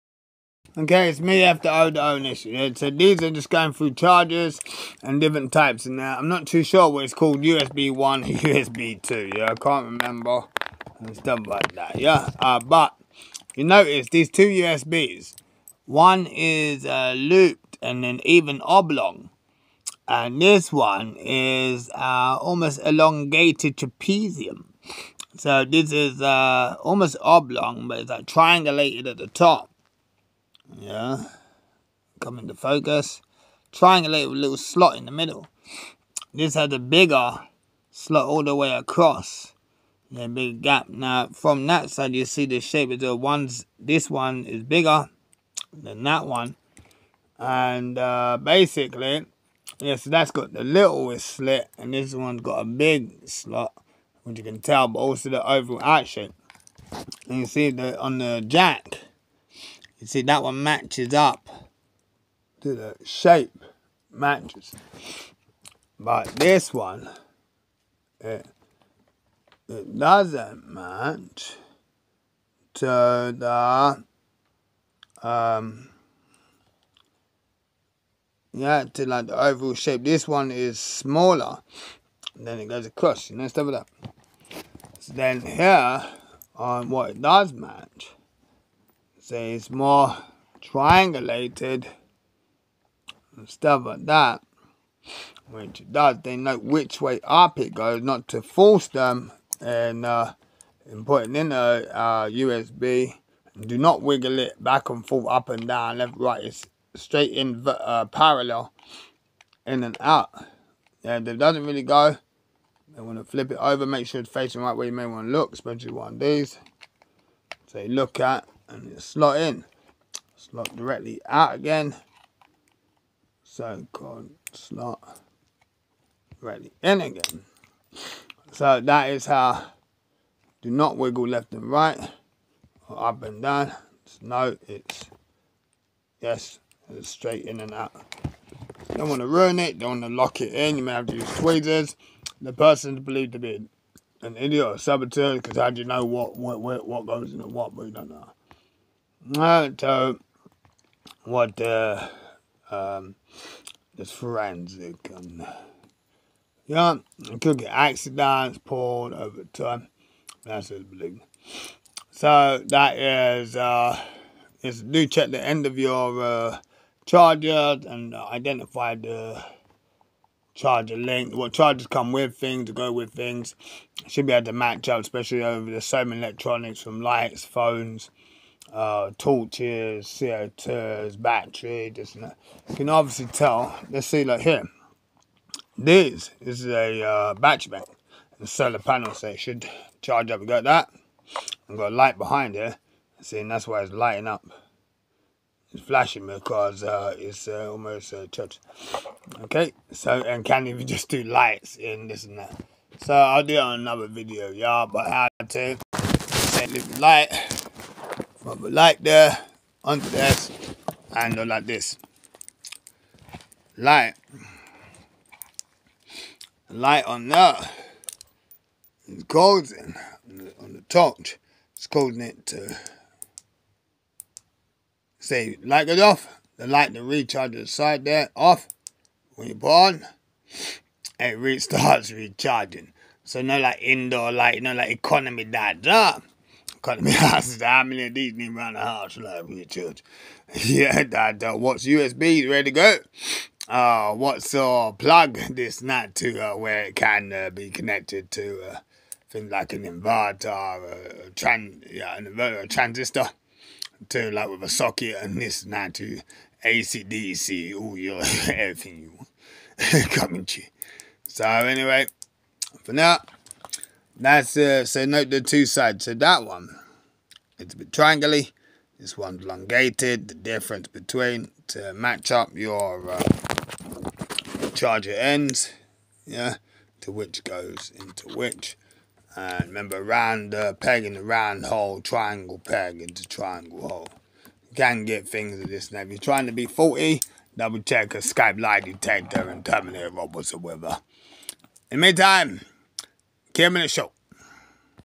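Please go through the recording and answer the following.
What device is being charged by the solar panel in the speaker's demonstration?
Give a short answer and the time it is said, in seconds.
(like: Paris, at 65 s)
Battery bank, at 187 s.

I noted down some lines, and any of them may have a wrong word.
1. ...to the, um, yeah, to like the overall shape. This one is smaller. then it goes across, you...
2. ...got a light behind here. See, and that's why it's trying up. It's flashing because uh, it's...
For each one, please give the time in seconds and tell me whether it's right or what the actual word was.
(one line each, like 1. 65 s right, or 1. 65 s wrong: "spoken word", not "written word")
1. 72 s right
2. 191 s wrong: "lighting", not "trying".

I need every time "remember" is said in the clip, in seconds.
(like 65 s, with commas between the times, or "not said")
10 s, 279 s.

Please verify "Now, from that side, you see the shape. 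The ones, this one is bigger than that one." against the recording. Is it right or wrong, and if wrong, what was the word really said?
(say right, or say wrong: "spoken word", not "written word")
right.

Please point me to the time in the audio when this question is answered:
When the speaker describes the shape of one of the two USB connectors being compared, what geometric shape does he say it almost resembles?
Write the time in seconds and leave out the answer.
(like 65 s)
22 s.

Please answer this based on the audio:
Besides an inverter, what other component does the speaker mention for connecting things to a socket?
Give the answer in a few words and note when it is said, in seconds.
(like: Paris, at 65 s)
A transistor, at 252 s.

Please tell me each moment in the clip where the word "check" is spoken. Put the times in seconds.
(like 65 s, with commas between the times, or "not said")
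165 s, 287 s.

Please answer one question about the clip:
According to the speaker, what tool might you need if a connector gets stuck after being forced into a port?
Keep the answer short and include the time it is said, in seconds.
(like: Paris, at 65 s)
Tweezers, at 141 s.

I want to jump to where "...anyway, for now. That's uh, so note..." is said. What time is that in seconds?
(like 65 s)
261 s.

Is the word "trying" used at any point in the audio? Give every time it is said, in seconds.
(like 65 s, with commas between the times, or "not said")
286 s.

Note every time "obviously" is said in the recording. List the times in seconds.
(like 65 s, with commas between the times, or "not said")
182 s.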